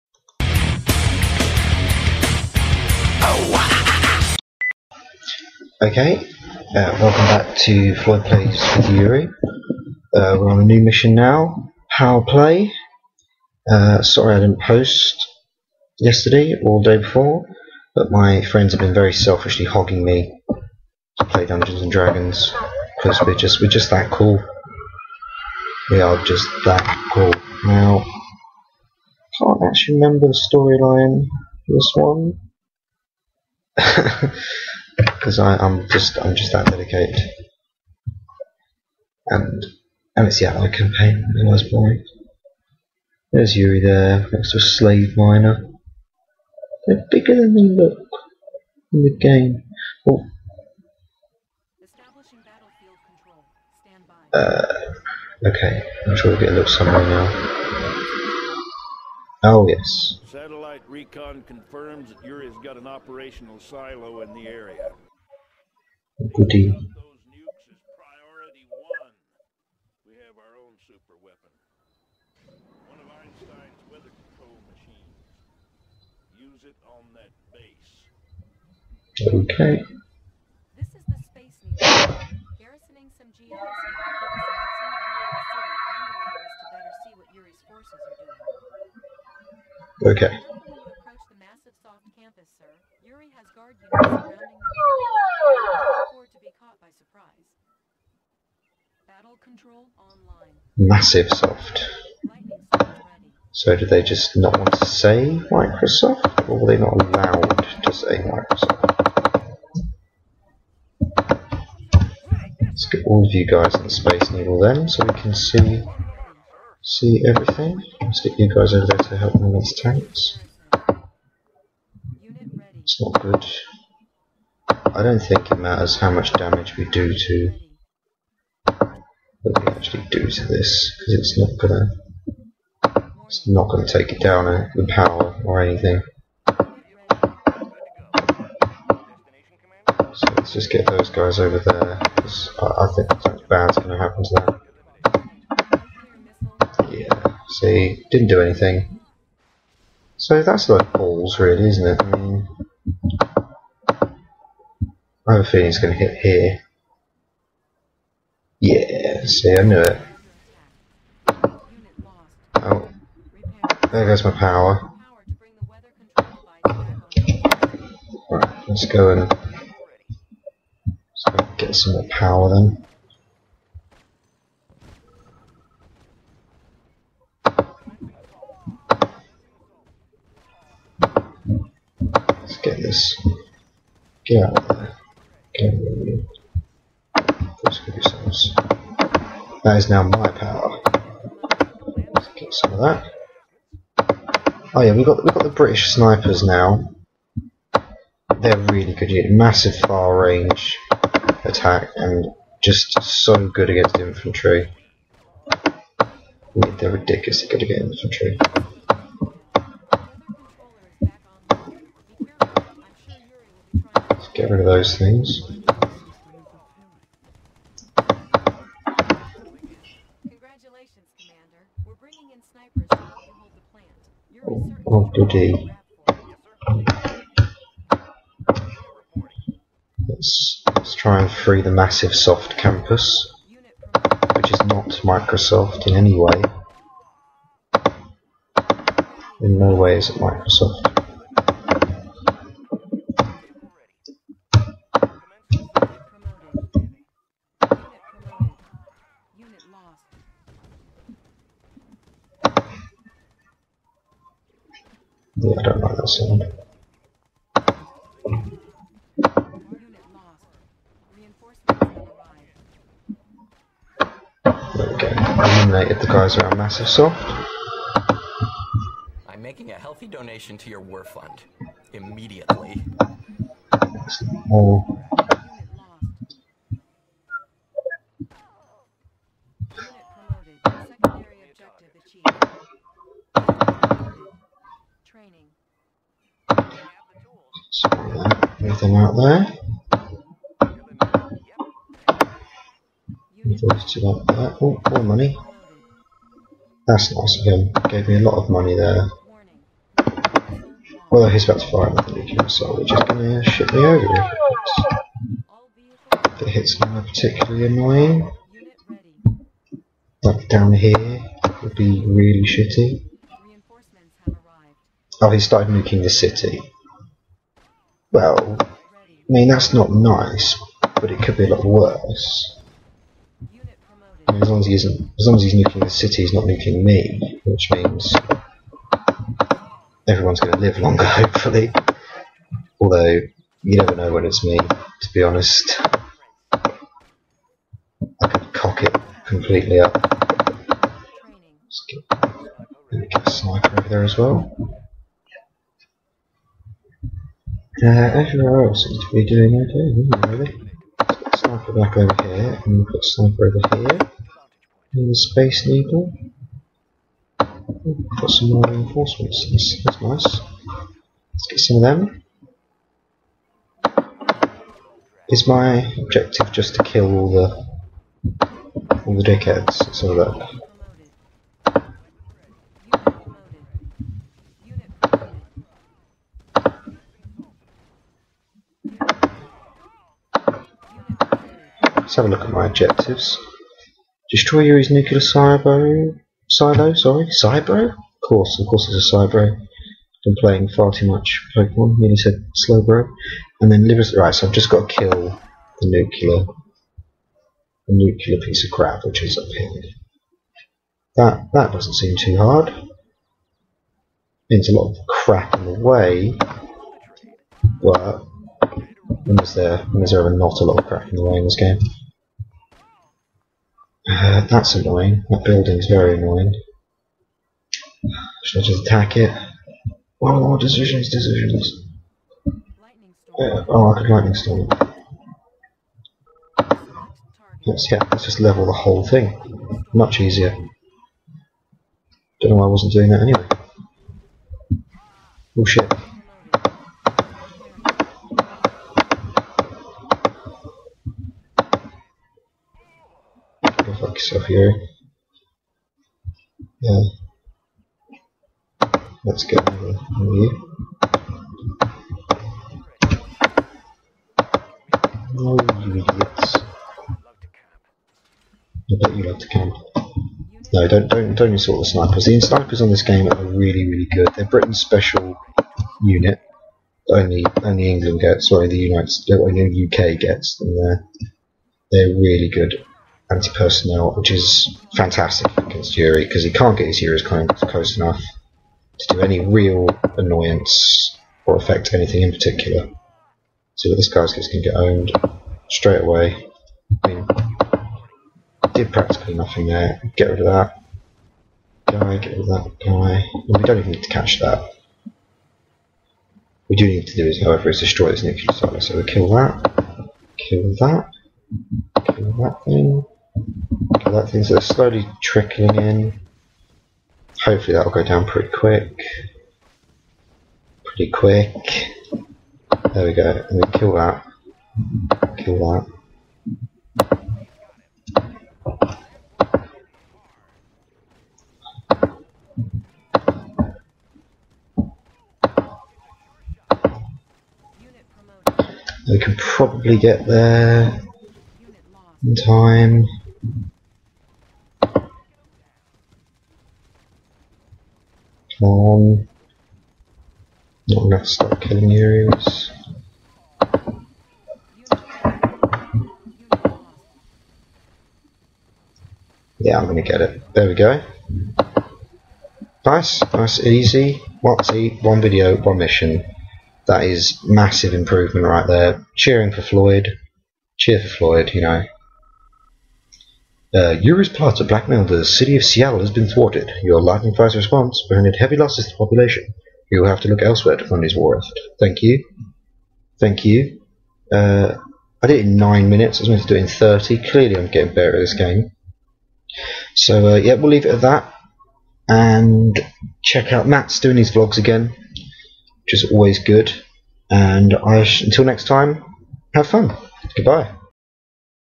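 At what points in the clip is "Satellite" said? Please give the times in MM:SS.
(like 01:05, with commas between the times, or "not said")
01:00.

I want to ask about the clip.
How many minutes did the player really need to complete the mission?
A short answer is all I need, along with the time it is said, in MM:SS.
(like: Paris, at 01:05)
9, at 09:35.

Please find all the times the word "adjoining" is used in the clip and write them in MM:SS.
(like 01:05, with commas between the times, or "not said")
not said.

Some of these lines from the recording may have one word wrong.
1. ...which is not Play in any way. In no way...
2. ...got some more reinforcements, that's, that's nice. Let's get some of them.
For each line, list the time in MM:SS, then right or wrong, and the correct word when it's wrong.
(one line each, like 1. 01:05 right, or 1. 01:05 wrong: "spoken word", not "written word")
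1. 03:54 wrong: "Microsoft", not "Play"
2. 05:58 right.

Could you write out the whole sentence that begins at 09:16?
That is massive improvement right there.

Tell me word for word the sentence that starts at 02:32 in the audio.
I mean, I have a feeling it's going to hit here.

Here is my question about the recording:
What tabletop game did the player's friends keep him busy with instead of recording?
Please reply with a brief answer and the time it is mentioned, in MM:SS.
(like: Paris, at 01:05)
Dungeons and Dragons, at 00:21.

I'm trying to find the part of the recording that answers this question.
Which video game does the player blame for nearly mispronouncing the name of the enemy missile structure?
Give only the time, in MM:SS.
06:31.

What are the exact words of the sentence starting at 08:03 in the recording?
So that this guy's just going to get owned straight away.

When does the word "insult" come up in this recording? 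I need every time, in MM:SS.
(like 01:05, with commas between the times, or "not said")
07:41.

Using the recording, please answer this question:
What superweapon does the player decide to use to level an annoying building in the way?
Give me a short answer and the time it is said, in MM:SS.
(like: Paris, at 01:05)
Lightning storm, at 07:04.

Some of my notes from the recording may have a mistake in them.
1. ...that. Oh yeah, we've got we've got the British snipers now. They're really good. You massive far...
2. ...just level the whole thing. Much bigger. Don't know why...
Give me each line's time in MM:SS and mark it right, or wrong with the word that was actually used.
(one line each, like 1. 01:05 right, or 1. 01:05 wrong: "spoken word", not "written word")
1. 03:12 right
2. 07:08 wrong: "easier", not "bigger".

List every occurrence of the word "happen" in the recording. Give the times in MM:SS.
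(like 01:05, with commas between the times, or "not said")
02:23.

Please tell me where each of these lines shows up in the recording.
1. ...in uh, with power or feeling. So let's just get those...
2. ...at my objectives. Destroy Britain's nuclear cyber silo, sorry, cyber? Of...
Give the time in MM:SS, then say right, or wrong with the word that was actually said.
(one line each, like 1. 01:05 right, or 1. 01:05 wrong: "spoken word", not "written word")
1. 02:14 wrong: "anything", not "feeling"
2. 06:22 wrong: "Yuri", not "Britain".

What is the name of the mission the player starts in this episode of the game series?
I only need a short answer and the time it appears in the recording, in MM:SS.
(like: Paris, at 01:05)
Power Play, at 00:11.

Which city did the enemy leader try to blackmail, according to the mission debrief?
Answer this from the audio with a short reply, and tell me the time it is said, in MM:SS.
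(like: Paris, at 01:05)
Seattle, at 09:25.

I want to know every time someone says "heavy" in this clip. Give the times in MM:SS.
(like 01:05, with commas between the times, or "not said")
09:28.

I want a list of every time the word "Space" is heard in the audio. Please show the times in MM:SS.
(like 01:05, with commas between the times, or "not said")
01:21, 01:53, 05:55.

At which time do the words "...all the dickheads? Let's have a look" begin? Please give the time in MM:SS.
06:09.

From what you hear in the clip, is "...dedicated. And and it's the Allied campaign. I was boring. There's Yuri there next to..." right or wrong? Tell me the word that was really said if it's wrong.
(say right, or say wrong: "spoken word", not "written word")
right.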